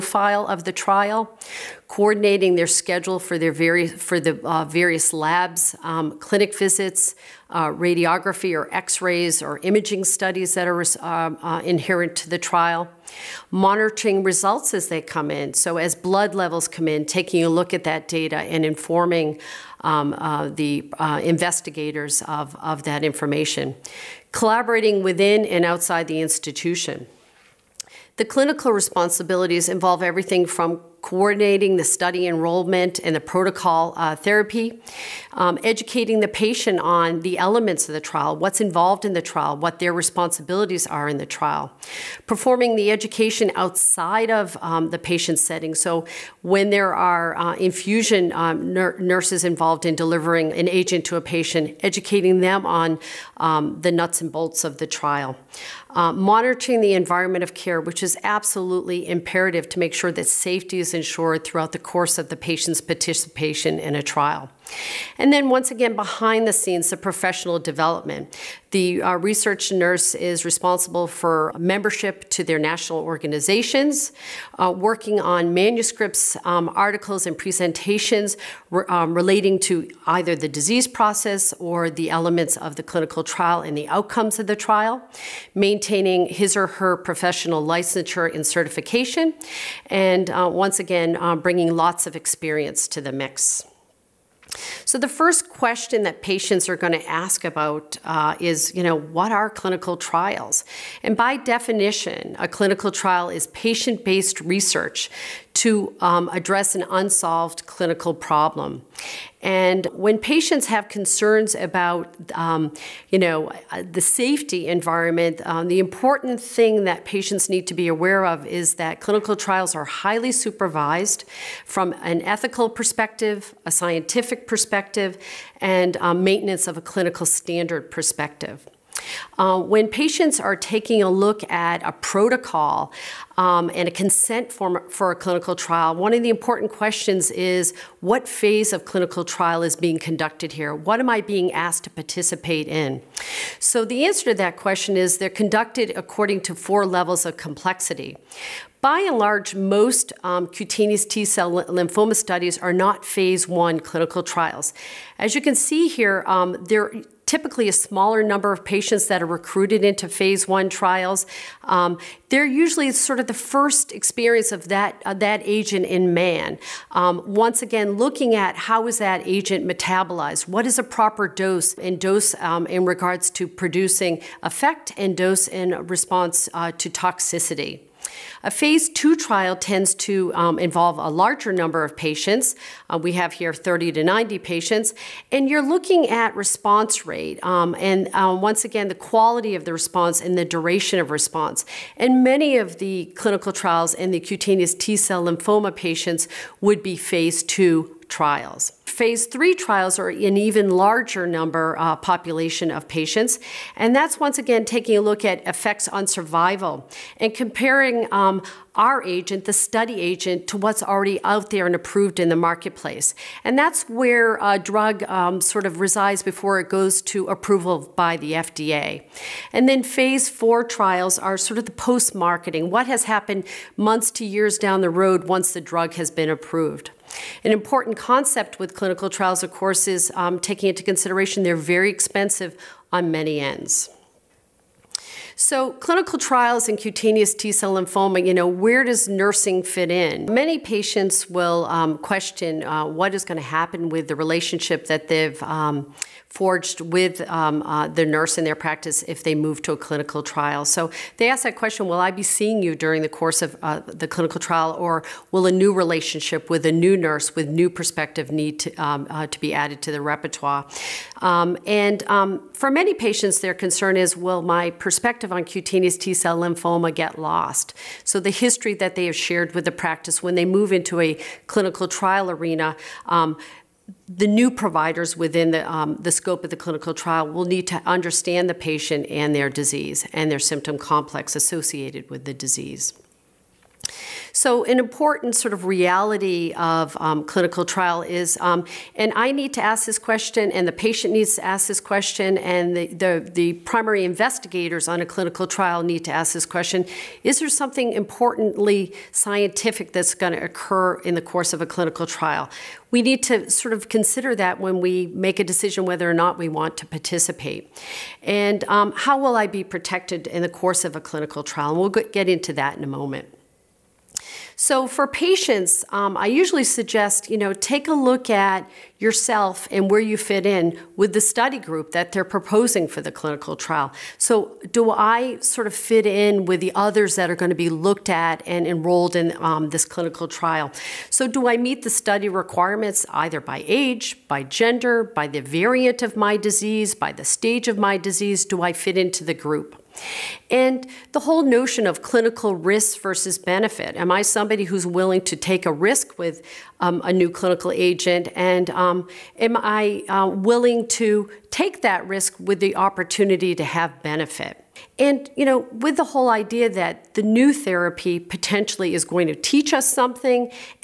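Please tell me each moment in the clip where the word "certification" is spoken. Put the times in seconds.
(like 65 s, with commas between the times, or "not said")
88 s.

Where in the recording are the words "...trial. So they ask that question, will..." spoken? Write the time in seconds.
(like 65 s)
250 s.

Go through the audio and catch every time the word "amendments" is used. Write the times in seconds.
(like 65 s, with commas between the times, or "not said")
not said.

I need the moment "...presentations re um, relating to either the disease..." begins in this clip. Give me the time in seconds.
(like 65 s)
77 s.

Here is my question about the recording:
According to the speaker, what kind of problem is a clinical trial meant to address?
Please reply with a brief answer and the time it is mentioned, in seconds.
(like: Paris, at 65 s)
an unsolved clinical problem, at 106 s.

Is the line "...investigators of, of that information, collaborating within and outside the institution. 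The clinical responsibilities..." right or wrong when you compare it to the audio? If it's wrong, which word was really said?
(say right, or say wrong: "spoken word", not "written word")
right.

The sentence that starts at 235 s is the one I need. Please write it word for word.
So clinical trials in cutaneous T-cell lymphoma, you know, where does nursing fit in?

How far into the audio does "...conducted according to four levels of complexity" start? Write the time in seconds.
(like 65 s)
145 s.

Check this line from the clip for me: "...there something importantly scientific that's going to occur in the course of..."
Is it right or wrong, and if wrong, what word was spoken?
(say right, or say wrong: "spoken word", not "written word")
right.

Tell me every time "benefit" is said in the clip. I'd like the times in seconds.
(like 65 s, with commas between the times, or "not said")
343 s, 354 s.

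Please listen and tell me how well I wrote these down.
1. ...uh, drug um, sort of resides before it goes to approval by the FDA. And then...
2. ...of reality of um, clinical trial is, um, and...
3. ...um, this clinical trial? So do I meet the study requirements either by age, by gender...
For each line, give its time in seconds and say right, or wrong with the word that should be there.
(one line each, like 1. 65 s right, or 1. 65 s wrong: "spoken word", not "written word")
1. 214 s right
2. 285 s right
3. 329 s right.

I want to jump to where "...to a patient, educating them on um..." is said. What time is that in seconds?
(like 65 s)
51 s.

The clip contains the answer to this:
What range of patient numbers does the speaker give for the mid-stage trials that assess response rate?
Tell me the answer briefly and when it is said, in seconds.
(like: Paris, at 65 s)
30 to 90, at 183 s.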